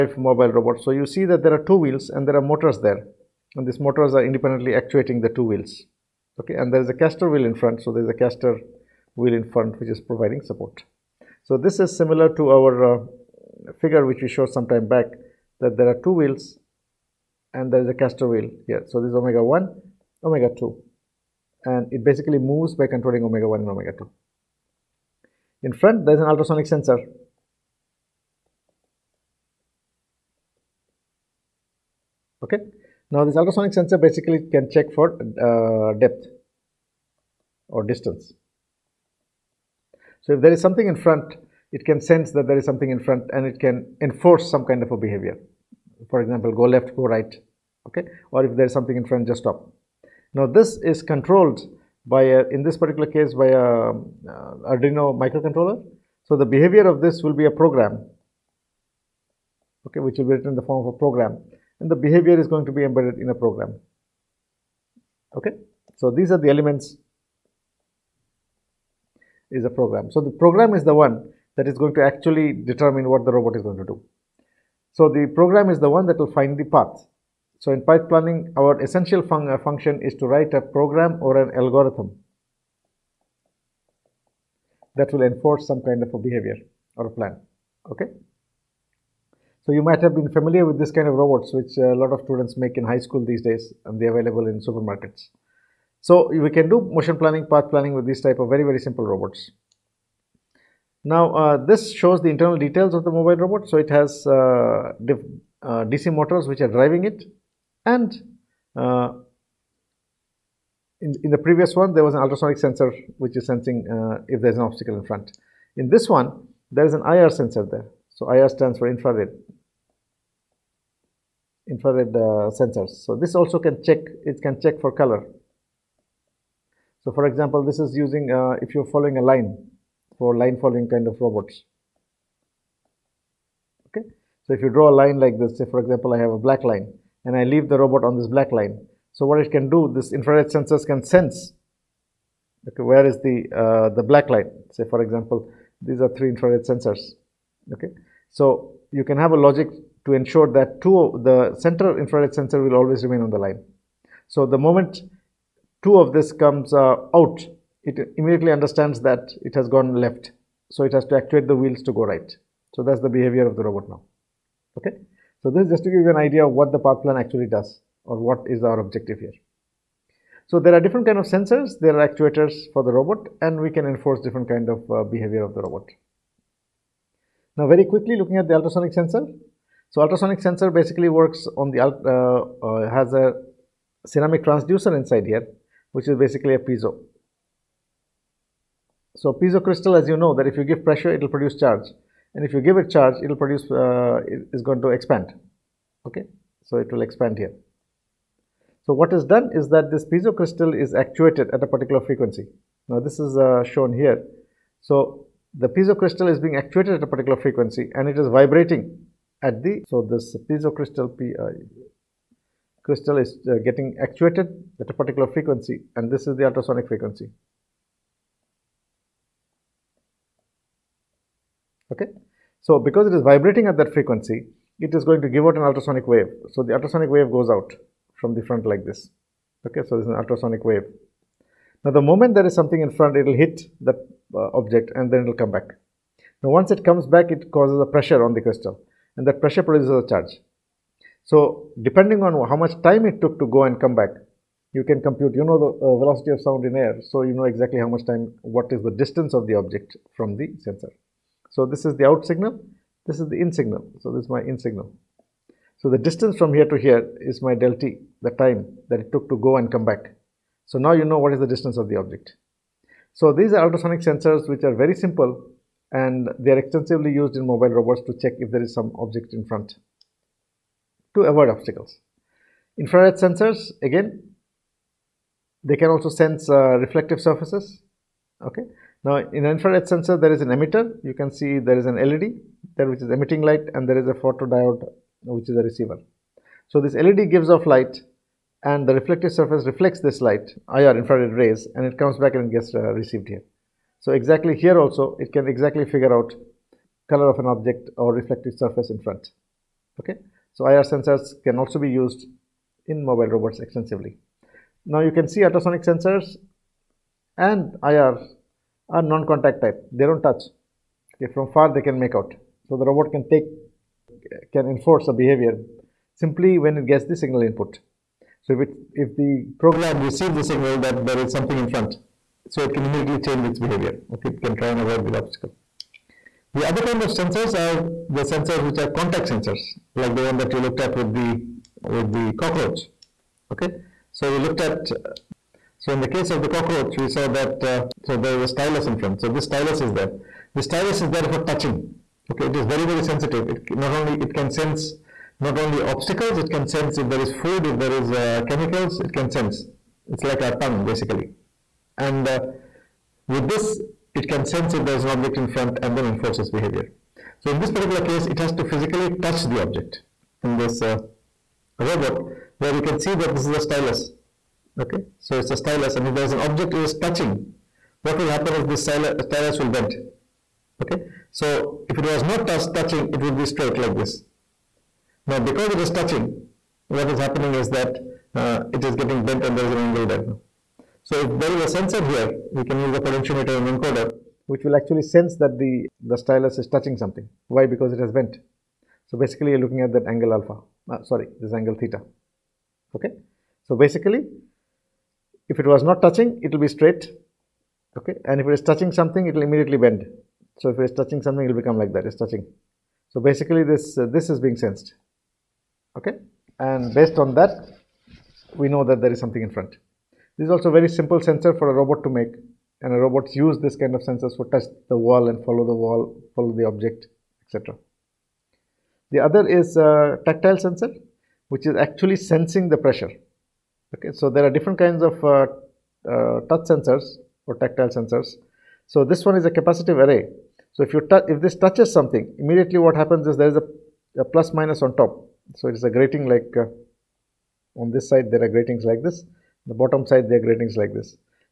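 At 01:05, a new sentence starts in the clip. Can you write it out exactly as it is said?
Okay, so these are the elements is a program.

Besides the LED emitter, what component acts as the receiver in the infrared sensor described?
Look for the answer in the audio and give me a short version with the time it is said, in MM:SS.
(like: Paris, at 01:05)
Photodiode, at 04:44.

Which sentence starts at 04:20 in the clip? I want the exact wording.
So now you know what is the distance of the object.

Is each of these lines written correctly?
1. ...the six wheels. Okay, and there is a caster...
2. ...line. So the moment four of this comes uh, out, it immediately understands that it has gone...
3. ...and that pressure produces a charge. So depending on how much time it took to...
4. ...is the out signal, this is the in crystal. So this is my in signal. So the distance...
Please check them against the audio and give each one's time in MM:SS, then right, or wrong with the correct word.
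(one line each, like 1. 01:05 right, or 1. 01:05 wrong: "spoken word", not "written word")
1. 00:05 wrong: "two", not "six"
2. 02:33 wrong: "two", not "four"
3. 03:59 right
4. 04:11 wrong: "signal", not "crystal".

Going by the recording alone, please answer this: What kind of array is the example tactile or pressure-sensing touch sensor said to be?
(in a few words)
Capacitive array.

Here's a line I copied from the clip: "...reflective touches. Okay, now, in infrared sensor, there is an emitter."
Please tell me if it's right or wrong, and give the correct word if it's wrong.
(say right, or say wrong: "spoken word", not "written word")
wrong: "surfaces", not "touches".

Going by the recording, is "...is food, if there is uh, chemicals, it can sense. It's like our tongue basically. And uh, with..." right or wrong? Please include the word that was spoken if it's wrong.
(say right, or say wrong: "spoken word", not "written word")
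right.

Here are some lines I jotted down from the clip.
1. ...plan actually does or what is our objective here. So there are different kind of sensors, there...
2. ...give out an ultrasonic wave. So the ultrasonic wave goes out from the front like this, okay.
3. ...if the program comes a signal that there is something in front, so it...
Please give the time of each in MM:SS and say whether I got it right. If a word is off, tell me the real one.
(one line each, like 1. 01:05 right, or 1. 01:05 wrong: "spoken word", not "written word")
1. 02:47 right
2. 03:45 right
3. 05:18 wrong: "receives", not "comes".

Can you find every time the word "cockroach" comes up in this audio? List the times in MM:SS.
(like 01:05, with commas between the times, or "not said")
05:32, 05:36.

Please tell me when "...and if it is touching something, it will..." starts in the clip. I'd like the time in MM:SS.
06:38.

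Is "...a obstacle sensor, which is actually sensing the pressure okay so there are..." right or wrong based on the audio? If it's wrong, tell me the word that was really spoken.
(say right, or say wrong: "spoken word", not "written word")
wrong: "tactile", not "obstacle".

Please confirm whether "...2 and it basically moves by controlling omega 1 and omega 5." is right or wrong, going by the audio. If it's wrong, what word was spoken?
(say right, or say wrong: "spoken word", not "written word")
wrong: "2", not "5".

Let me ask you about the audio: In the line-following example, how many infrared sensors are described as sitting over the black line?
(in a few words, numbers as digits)
3.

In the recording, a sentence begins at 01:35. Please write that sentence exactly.
So we can do motion planning, path planning with these type of very, very simple robots.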